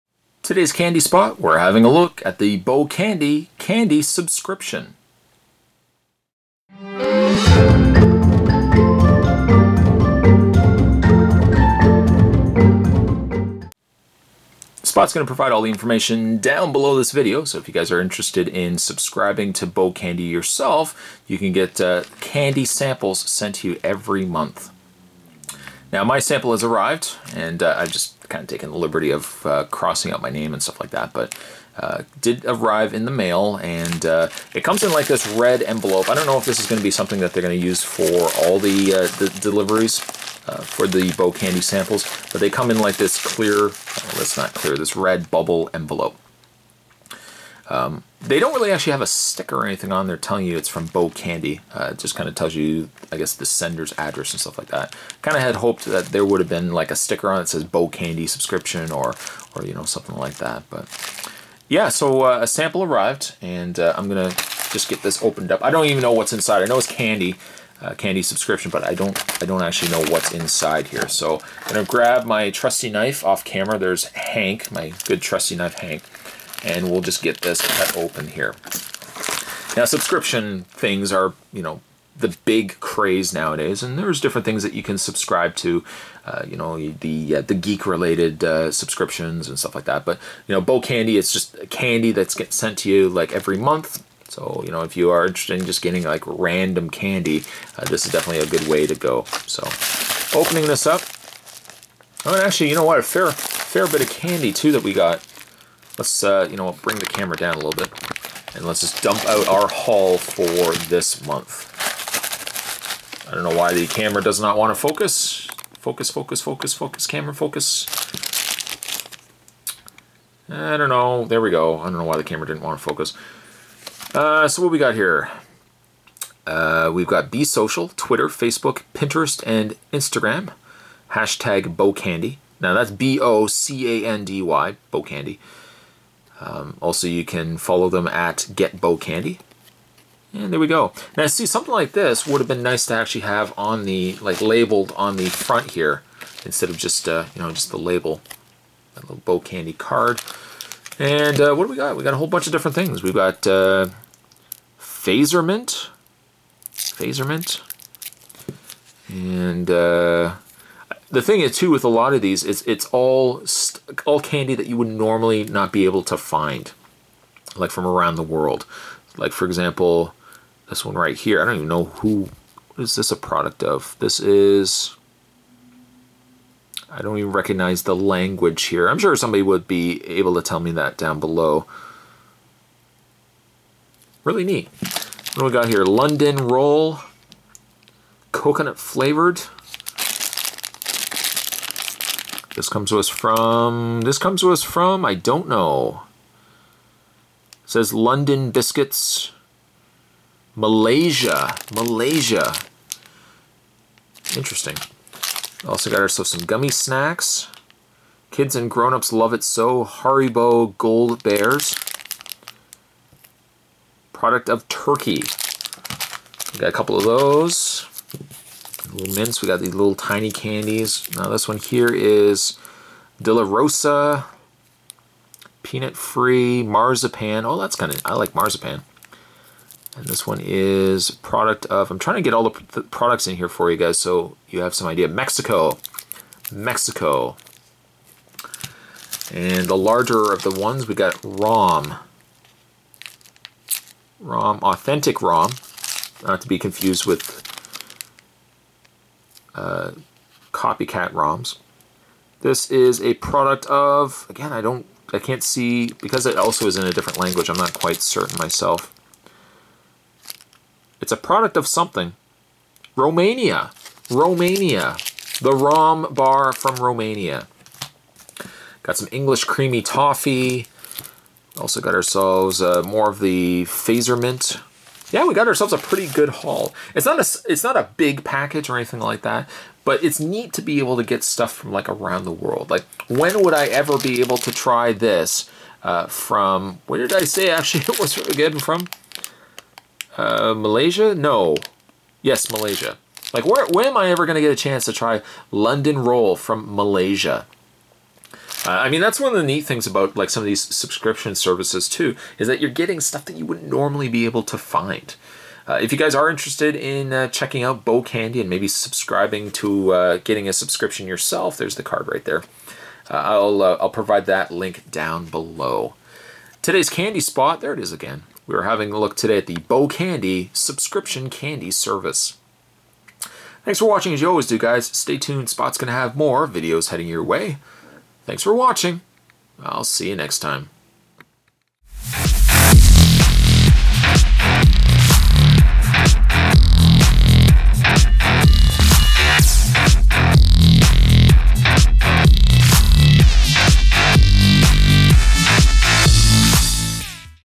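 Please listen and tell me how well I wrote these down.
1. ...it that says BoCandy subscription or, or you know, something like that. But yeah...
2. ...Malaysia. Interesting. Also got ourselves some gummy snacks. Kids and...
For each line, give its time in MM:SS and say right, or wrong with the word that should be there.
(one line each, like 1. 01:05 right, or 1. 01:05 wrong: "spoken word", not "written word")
1. 00:57 right
2. 03:21 right.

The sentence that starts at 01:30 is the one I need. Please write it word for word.
But you know, BoCandy, it's just candy that's get sent to you like every month.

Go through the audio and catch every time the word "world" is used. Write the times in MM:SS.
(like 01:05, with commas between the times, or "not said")
02:48, 04:42.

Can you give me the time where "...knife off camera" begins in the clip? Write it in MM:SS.
01:12.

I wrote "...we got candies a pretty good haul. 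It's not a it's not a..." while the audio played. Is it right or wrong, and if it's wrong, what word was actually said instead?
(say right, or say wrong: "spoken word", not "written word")
wrong: "ourselves", not "candies".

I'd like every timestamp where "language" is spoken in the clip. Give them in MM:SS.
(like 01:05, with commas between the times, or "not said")
02:57, 04:17.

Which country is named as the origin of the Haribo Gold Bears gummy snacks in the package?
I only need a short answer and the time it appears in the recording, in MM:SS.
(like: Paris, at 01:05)
Turkey, at 03:34.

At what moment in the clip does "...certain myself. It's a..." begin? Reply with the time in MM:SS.
04:18.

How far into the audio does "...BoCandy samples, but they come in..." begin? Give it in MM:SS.
00:41.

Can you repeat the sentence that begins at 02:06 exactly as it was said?
Uh, we've got Be Social, Twitter, Facebook, Pinterest, and Instagram.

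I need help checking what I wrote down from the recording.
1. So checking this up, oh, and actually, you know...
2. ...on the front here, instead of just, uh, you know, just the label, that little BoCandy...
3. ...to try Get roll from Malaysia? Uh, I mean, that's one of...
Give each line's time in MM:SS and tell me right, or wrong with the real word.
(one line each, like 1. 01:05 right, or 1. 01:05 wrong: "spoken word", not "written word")
1. 01:39 wrong: "opening", not "checking"
2. 02:24 right
3. 04:54 wrong: "London", not "Get".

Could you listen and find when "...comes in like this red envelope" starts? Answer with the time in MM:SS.
00:34.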